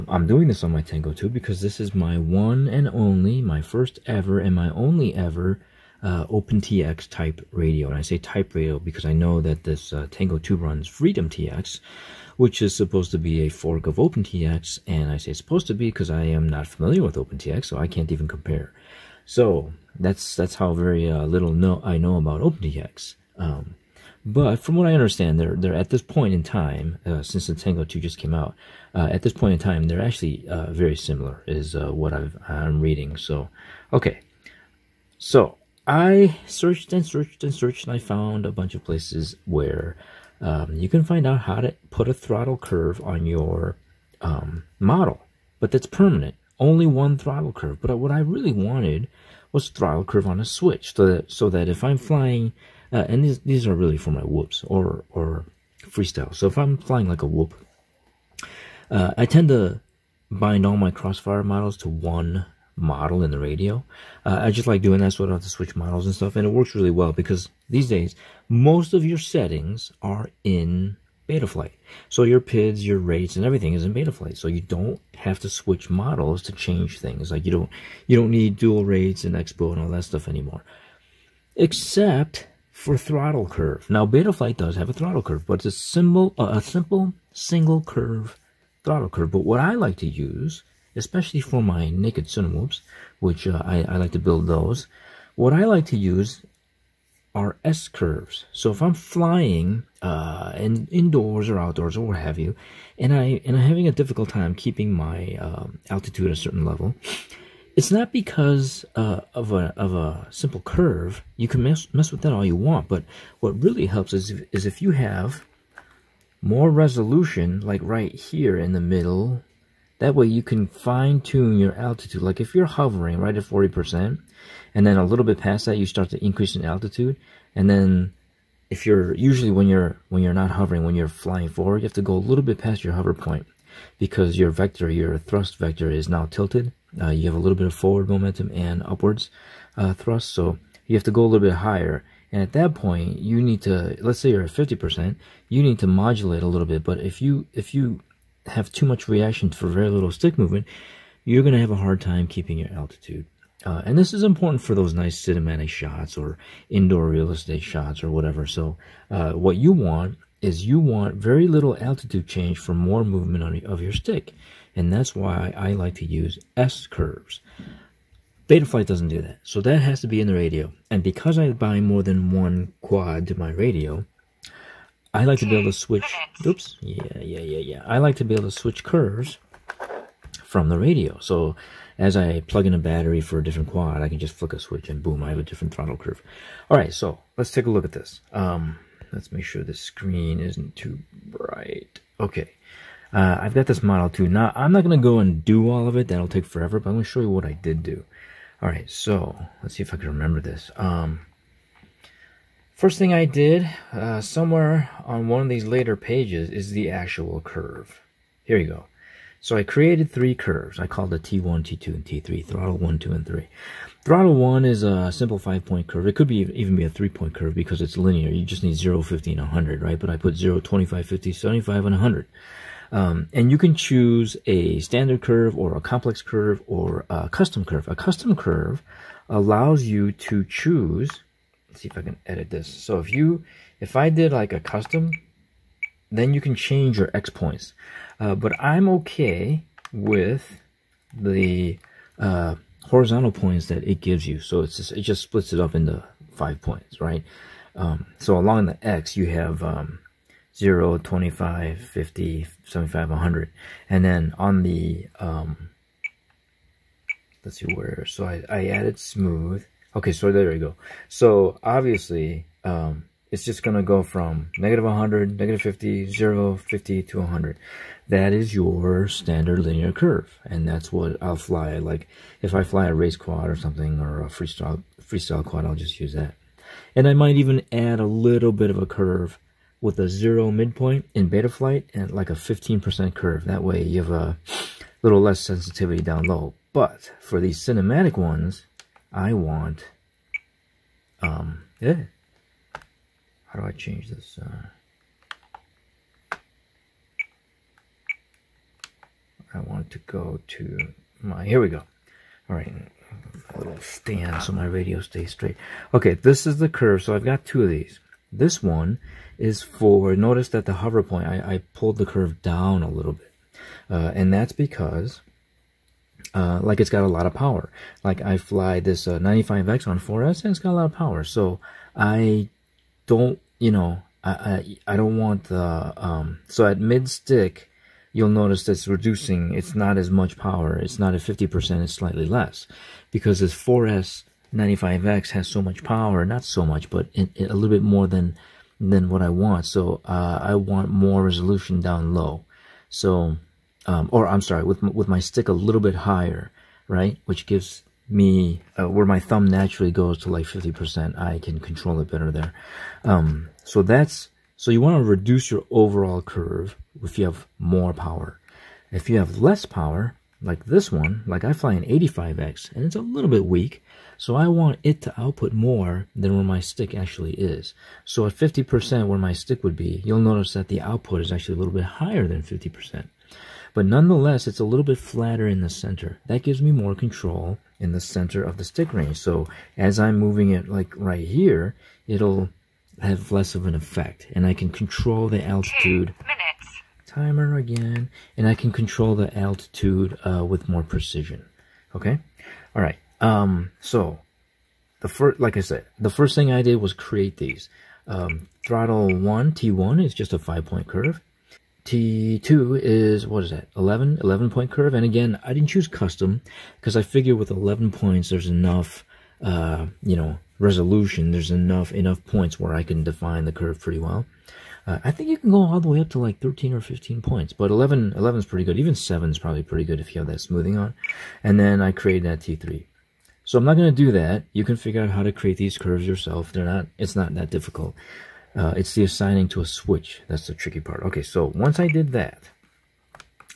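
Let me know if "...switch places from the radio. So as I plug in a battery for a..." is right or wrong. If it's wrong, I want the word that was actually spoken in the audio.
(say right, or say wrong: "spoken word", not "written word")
wrong: "curves", not "places".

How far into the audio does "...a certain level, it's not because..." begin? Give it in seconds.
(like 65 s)
106 s.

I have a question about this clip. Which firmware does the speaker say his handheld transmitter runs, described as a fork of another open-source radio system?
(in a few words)
Freedom TX.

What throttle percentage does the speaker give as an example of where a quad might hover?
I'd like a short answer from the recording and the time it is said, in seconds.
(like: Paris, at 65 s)
40%, at 123 s.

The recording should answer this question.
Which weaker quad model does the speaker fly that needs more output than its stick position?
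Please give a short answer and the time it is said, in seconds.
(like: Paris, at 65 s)
85X, at 361 s.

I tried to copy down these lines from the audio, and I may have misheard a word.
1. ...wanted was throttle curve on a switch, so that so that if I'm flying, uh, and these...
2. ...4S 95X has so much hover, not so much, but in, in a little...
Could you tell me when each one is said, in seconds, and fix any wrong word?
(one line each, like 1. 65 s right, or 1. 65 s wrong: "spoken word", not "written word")
1. 48 s right
2. 333 s wrong: "power", not "hover".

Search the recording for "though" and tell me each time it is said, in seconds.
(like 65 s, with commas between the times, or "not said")
not said.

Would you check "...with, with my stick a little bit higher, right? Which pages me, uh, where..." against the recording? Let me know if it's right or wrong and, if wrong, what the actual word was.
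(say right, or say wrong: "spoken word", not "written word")
wrong: "gives", not "pages".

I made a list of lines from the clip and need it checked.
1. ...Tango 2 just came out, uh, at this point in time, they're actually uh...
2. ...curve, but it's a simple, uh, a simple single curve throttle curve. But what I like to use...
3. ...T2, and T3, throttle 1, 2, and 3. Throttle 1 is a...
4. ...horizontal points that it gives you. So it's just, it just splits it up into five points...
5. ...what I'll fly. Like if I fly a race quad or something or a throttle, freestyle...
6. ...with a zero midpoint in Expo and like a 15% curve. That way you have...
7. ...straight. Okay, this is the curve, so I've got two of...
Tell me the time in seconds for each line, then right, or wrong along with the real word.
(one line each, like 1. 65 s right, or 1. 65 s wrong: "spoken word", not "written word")
1. 27 s right
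2. 85 s right
3. 211 s right
4. 242 s right
5. 270 s wrong: "freestyle", not "throttle"
6. 279 s wrong: "Betaflight", not "Expo"
7. 305 s right.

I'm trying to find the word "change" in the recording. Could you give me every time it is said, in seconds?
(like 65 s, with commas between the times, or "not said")
76 s, 162 s, 236 s, 293 s.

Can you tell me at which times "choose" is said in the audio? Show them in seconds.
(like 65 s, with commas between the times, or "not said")
223 s, 230 s, 405 s.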